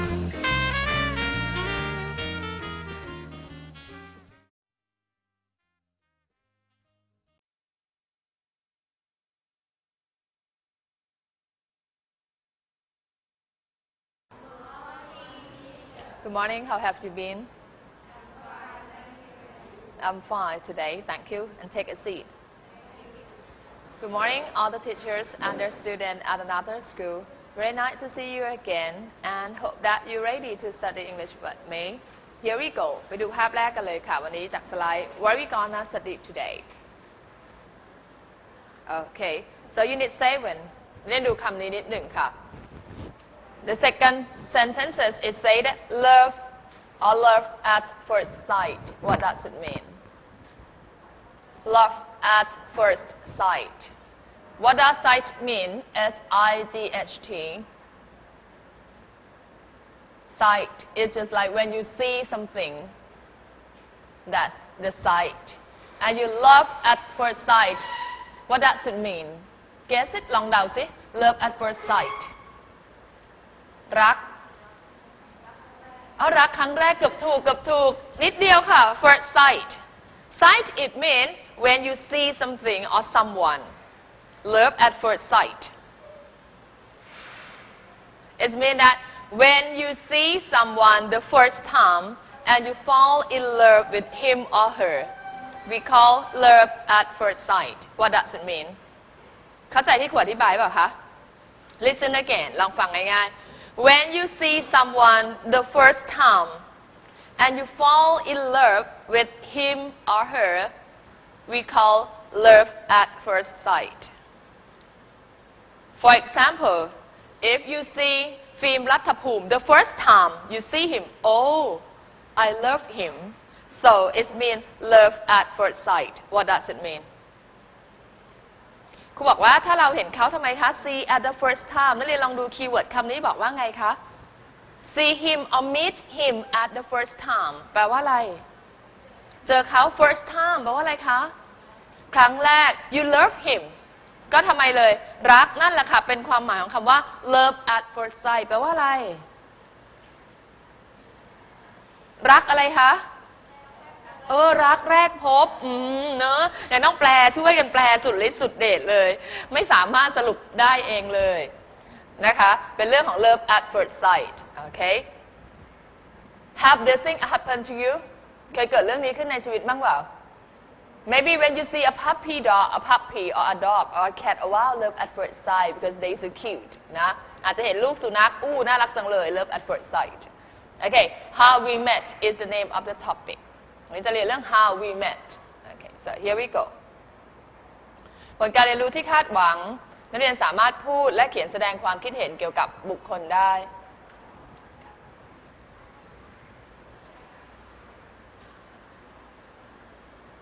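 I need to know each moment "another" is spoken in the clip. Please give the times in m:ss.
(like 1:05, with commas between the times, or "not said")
0:26.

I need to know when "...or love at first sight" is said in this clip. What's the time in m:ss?
0:47.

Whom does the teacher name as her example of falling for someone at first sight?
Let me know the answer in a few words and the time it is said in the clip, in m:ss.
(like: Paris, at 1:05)
Phim Latapoom, at 1:58.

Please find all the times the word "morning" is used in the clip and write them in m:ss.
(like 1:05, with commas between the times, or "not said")
0:16, 0:24.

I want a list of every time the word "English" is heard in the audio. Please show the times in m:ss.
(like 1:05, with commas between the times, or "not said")
0:31.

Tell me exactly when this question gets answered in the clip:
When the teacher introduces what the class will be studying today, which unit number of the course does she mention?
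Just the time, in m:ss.
0:39.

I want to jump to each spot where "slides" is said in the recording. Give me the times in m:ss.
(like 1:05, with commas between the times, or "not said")
not said.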